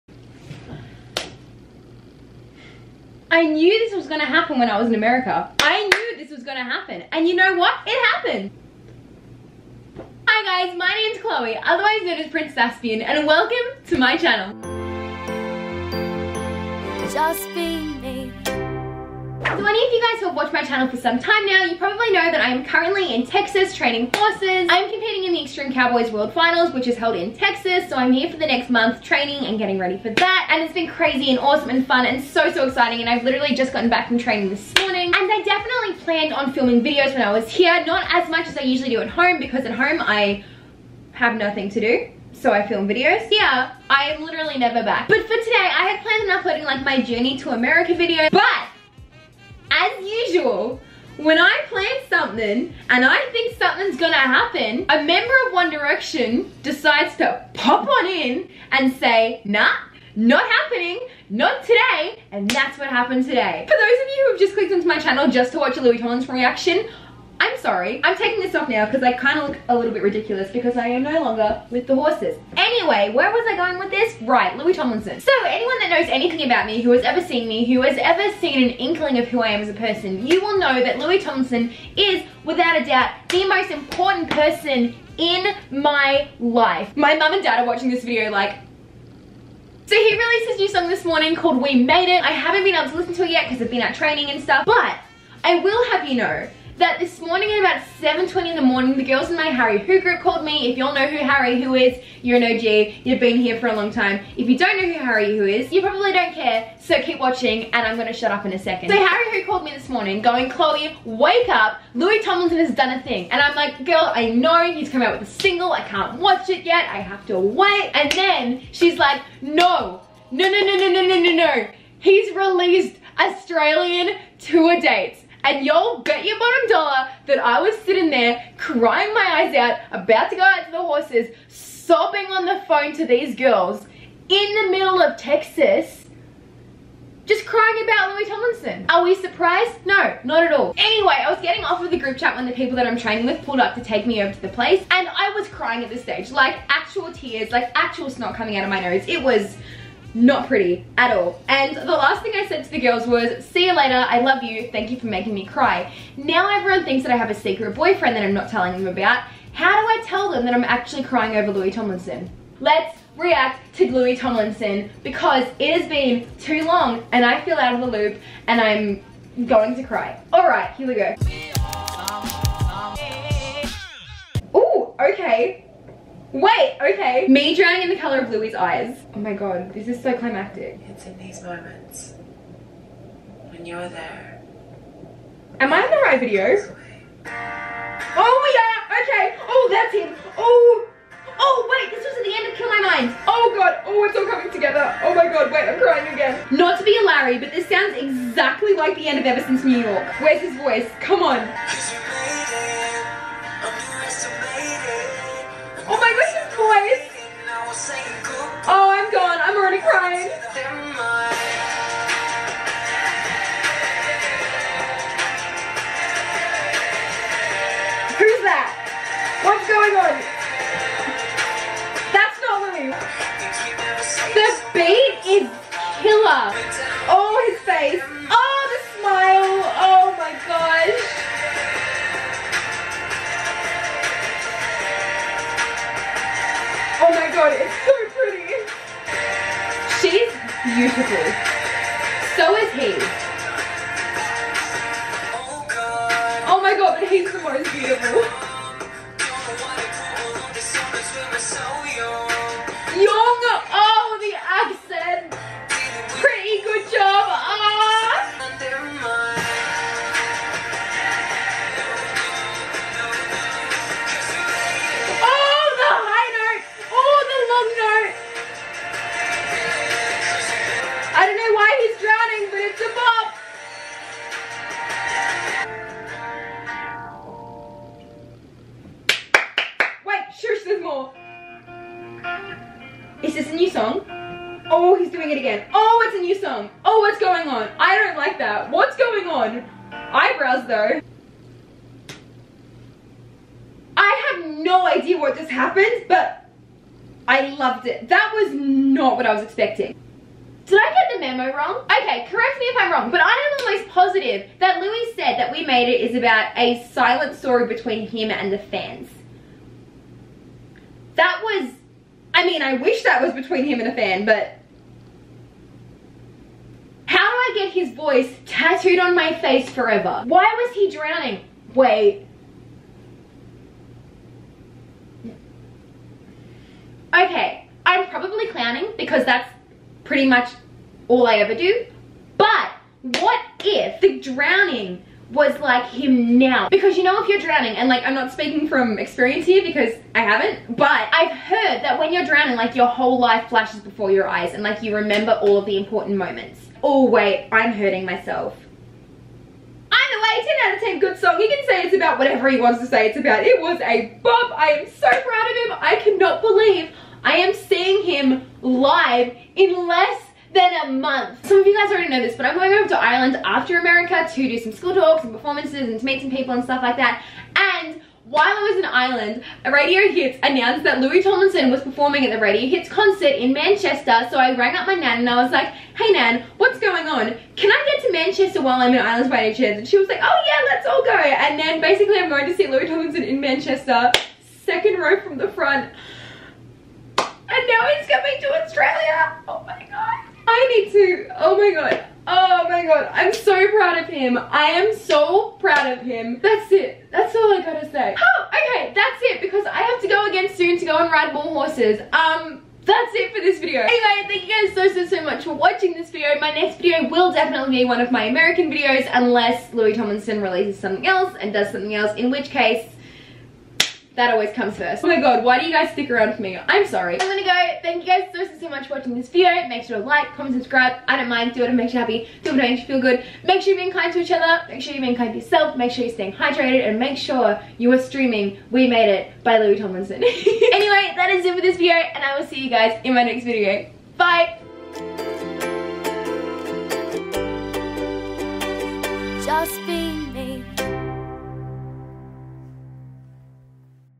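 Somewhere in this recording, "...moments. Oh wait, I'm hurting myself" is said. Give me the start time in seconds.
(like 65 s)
346 s.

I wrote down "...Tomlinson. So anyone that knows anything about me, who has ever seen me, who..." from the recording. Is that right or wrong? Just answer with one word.
right.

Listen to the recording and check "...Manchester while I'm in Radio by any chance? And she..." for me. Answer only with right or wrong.
wrong.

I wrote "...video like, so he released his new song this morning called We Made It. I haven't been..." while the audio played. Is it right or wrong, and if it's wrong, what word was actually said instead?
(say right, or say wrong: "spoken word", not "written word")
right.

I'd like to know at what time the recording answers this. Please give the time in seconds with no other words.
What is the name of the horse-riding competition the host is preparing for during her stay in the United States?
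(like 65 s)
25 s.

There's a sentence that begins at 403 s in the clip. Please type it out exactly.
Anyway, thank you guys so, so, so much for watching this video.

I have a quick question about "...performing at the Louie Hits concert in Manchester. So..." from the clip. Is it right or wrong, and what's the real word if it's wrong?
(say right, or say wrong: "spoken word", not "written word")
wrong: "Radio", not "Louie".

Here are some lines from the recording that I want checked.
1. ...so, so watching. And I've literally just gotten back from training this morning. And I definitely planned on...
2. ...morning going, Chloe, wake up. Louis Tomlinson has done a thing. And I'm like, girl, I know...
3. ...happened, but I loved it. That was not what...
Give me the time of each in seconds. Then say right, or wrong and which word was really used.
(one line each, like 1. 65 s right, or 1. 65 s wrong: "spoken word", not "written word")
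1. 32 s wrong: "exciting", not "watching"
2. 109 s right
3. 295 s right.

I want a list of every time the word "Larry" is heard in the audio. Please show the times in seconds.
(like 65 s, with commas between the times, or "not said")
197 s.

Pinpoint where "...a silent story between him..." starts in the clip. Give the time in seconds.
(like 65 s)
306 s.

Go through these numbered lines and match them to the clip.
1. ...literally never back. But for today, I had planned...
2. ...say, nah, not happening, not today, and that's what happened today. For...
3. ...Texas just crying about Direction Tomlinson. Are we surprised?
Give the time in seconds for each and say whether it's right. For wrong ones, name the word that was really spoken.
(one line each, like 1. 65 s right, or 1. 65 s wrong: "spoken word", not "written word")
1. 44 s right
2. 58 s right
3. 135 s wrong: "Louis", not "Direction".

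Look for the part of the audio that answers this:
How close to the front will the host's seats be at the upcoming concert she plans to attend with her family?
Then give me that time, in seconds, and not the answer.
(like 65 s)
384 s.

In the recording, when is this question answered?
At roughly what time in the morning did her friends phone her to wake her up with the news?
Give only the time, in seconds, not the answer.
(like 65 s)
97 s.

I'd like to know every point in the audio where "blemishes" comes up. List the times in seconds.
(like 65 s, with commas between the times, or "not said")
not said.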